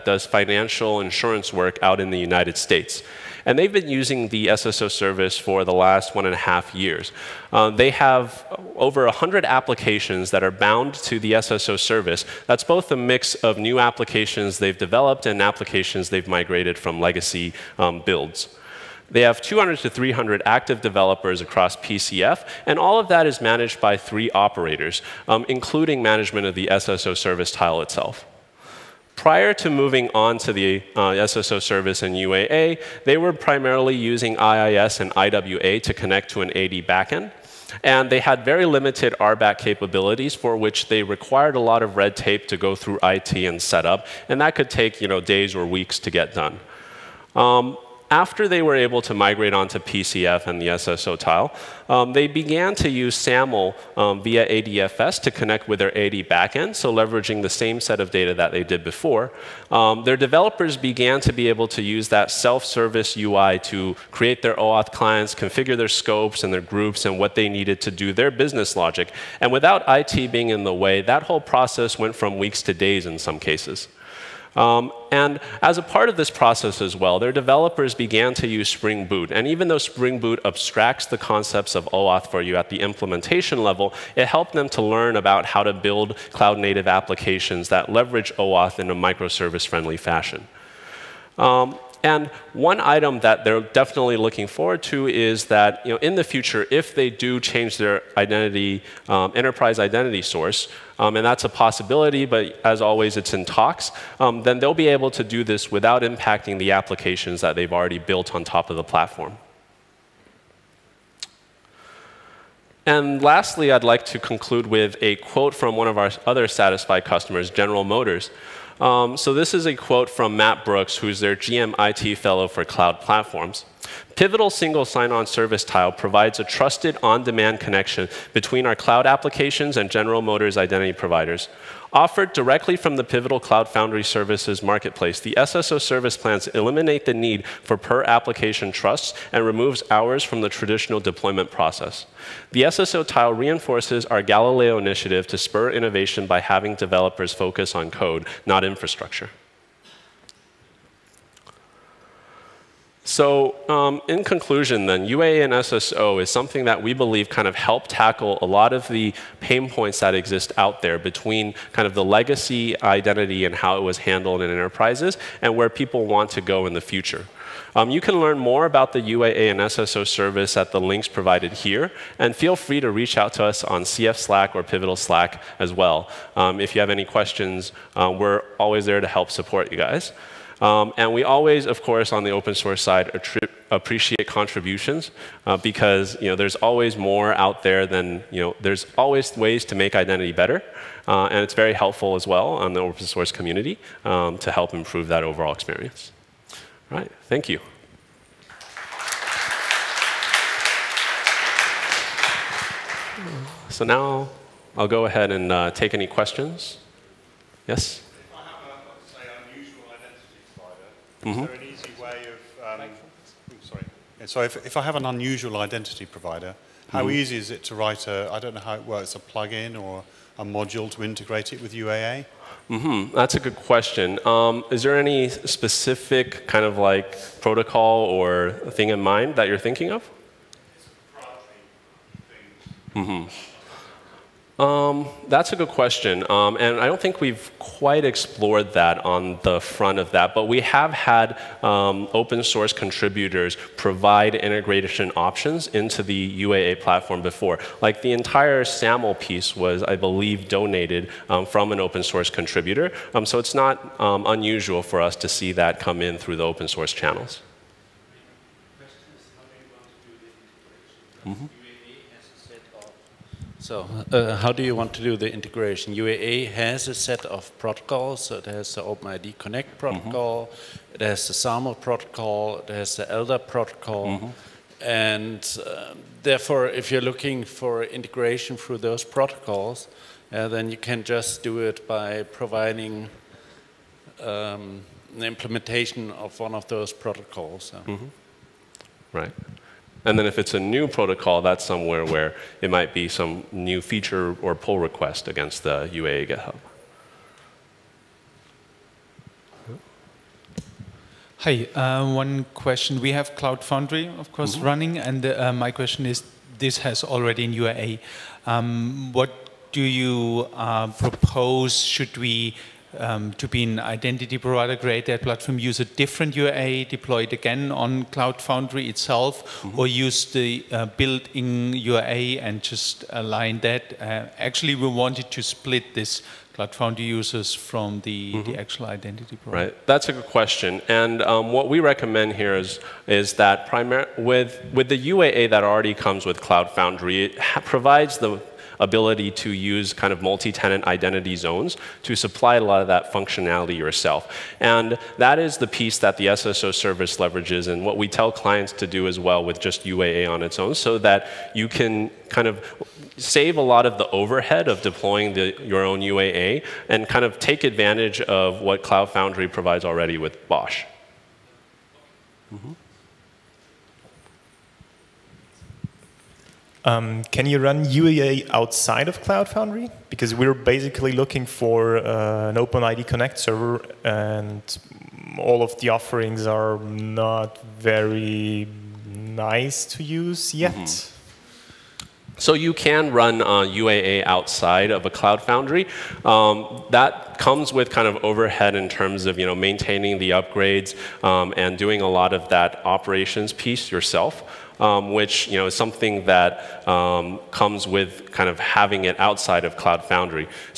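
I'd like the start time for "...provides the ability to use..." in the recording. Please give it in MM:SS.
05:37.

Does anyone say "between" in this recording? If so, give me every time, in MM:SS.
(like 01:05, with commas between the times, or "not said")
02:08, 02:40.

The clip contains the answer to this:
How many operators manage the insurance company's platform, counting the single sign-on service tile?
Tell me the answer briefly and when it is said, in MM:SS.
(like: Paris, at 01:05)
3, at 00:23.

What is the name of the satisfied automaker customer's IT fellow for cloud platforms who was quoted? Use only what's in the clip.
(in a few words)
Matt Brooks.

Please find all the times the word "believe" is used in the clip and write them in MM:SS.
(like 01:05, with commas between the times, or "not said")
02:36, 04:09.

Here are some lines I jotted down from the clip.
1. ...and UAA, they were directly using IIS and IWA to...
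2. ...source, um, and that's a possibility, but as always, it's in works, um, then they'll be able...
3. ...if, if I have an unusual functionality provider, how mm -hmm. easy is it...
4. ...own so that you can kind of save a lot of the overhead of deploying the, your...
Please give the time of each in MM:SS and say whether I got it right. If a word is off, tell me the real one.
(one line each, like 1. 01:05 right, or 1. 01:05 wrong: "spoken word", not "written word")
1. 00:32 wrong: "primarily", not "directly"
2. 01:40 wrong: "talks", not "works"
3. 03:34 wrong: "identity", not "functionality"
4. 05:50 right.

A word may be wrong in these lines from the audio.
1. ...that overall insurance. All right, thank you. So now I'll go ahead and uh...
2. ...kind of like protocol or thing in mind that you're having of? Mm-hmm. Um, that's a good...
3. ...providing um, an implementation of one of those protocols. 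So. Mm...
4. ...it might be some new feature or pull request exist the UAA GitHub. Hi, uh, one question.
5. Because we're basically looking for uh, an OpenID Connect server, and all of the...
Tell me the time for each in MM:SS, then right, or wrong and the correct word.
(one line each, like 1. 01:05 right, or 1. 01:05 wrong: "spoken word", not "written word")
1. 03:15 wrong: "experience", not "insurance"
2. 03:46 wrong: "thinking", not "having"
3. 04:42 right
4. 04:52 wrong: "against", not "exist"
5. 06:10 right.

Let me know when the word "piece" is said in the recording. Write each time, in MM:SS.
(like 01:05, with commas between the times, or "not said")
04:09, 05:45, 06:33.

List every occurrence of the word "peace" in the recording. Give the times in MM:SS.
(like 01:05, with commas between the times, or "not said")
not said.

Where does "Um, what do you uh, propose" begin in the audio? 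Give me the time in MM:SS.
05:08.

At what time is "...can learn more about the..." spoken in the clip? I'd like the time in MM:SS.
02:48.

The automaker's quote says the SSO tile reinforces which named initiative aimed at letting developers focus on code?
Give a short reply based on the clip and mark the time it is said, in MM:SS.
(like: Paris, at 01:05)
Galileo, at 02:24.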